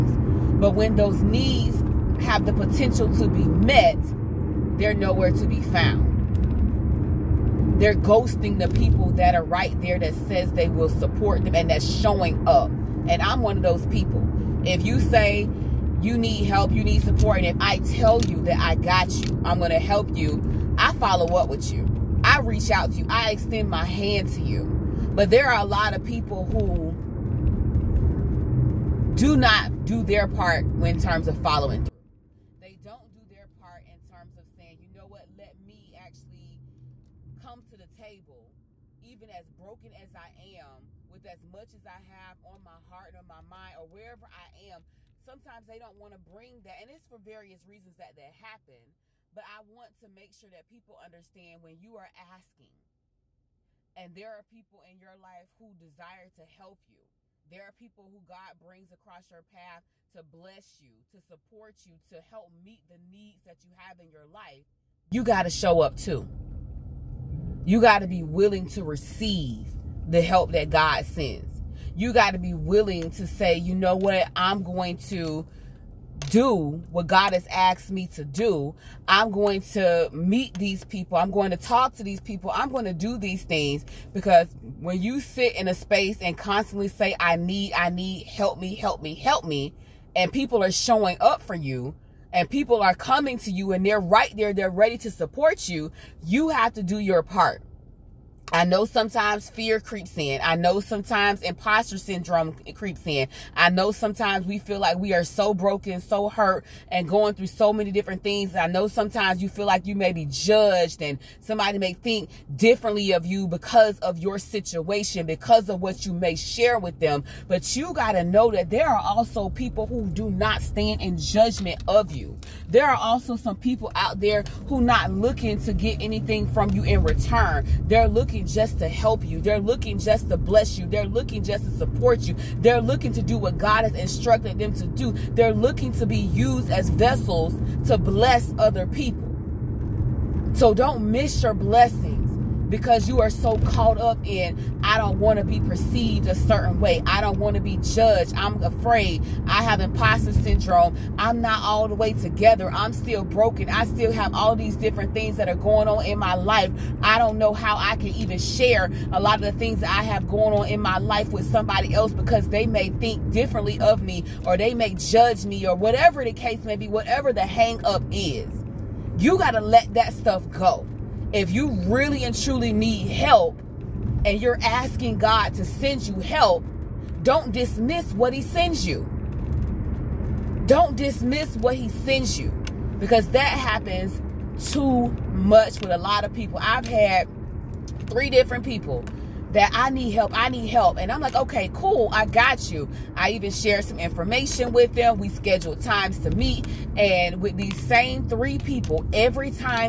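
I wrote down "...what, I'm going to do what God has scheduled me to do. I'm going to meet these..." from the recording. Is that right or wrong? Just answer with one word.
wrong.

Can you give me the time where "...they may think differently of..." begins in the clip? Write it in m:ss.
2:42.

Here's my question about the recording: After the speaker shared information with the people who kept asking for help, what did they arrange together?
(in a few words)
times to meet.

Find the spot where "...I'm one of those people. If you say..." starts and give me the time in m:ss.
0:13.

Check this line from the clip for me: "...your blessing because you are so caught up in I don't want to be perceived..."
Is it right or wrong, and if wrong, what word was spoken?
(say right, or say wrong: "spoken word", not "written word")
right.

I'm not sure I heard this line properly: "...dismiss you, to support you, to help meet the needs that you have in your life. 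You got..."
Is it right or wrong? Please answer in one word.
wrong.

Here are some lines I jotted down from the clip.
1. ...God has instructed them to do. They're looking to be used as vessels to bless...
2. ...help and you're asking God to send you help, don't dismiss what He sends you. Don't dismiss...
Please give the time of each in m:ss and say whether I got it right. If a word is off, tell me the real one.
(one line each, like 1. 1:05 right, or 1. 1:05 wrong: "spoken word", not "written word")
1. 2:13 right
2. 2:53 right.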